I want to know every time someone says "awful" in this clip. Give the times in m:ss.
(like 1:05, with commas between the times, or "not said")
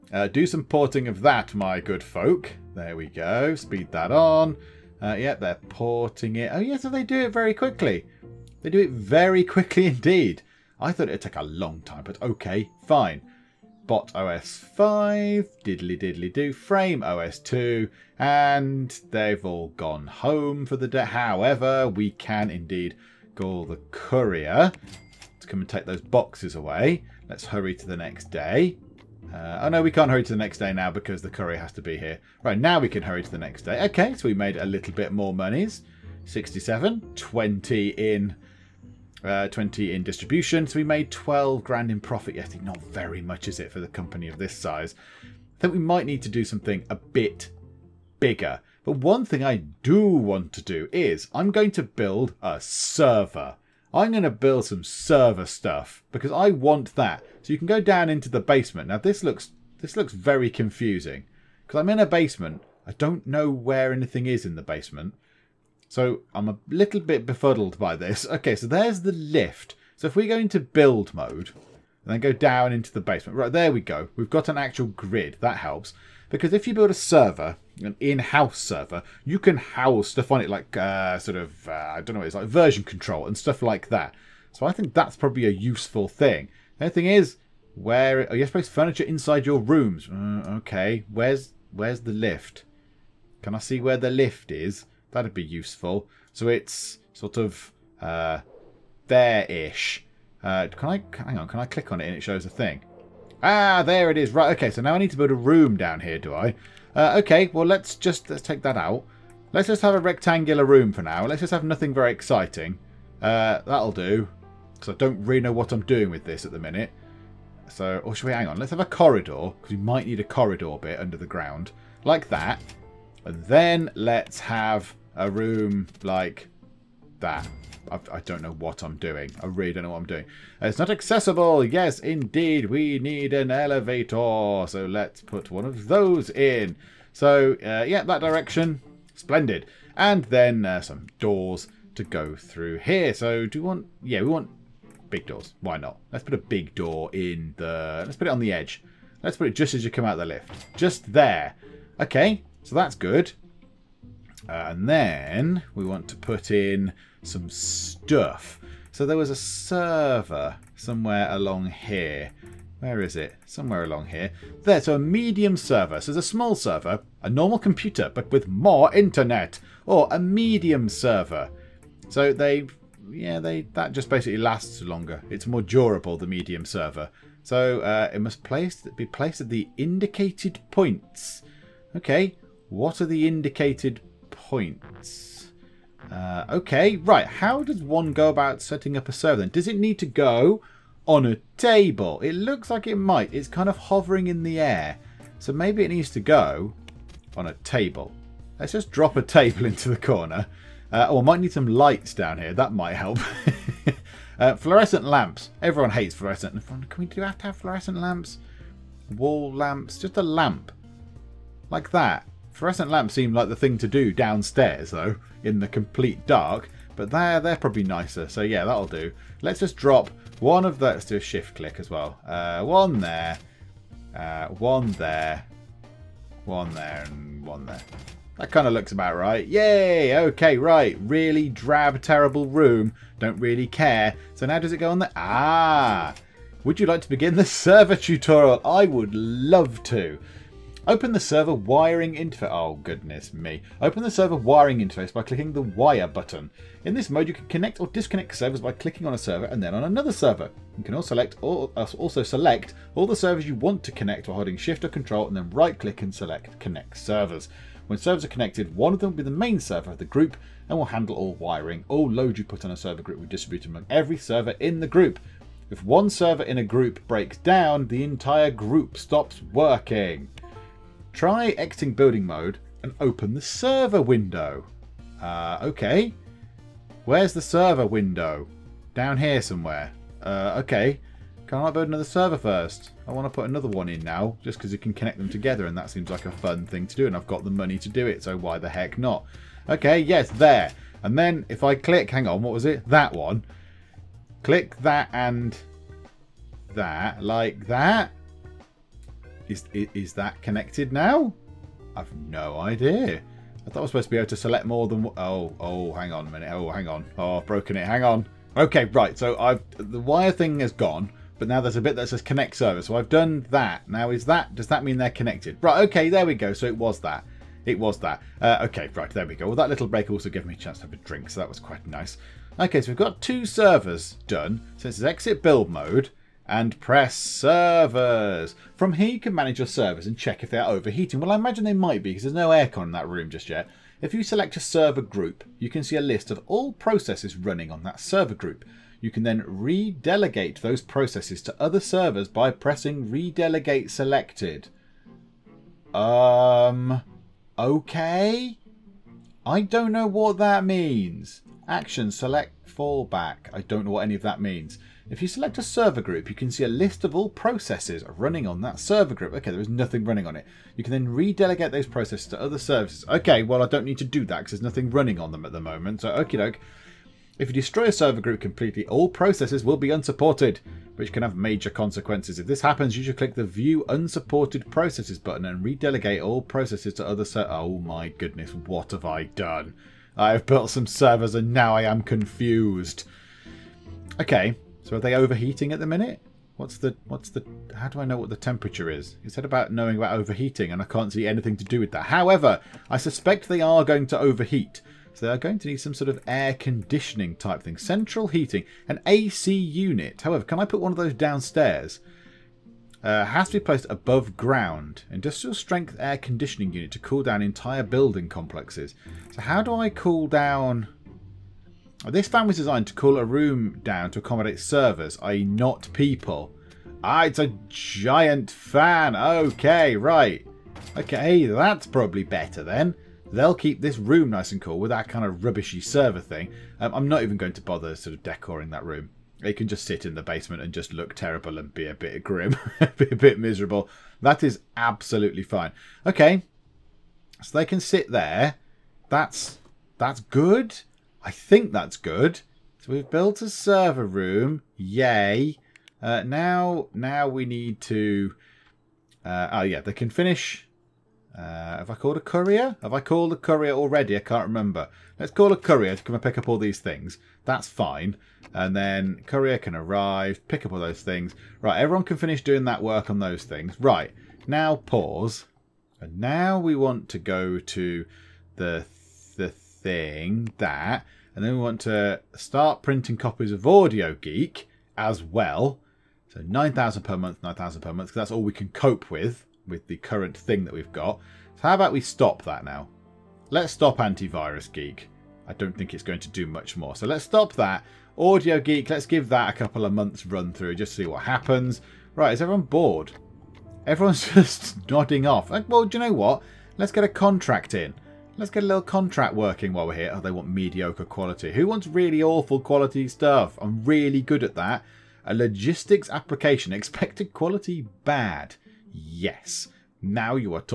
8:22.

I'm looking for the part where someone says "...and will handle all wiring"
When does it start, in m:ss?
4:20.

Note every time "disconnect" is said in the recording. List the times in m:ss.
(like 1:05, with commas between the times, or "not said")
4:07.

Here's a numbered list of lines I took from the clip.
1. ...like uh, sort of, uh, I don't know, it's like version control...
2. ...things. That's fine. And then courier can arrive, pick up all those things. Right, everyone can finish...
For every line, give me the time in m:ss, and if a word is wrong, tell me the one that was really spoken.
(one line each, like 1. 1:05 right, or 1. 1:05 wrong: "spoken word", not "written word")
1. 1:20 right
2. 7:36 right.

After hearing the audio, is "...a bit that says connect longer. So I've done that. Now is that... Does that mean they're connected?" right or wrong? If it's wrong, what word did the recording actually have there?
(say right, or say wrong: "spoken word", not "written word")
wrong: "server", not "longer".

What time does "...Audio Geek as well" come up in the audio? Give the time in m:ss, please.
7:53.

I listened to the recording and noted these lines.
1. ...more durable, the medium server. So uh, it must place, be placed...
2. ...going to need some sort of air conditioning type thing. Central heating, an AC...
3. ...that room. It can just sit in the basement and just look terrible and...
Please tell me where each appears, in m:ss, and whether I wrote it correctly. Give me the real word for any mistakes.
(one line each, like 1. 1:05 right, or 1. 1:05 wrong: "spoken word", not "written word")
1. 2:55 right
2. 6:35 right
3. 7:08 right.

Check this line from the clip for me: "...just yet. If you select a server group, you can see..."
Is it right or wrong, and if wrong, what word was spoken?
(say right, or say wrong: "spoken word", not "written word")
right.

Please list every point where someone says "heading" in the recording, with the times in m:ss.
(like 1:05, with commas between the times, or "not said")
not said.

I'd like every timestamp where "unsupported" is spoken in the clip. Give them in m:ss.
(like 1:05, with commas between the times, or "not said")
6:09, 6:13.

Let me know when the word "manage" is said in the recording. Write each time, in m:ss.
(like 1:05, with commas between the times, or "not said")
5:29.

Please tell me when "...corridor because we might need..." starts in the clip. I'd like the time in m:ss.
1:58.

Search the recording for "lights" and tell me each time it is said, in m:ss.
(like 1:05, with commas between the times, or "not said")
3:21.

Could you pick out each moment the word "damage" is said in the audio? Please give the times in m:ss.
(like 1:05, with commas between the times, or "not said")
not said.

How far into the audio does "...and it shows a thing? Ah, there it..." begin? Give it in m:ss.
1:42.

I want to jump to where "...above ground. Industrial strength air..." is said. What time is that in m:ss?
6:43.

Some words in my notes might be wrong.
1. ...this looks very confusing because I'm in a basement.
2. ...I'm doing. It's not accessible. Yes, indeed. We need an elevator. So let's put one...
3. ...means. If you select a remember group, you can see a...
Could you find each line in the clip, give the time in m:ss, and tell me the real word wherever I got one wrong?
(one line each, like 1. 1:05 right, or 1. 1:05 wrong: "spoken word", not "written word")
1. 0:59 right
2. 2:09 right
3. 5:54 wrong: "server", not "remember".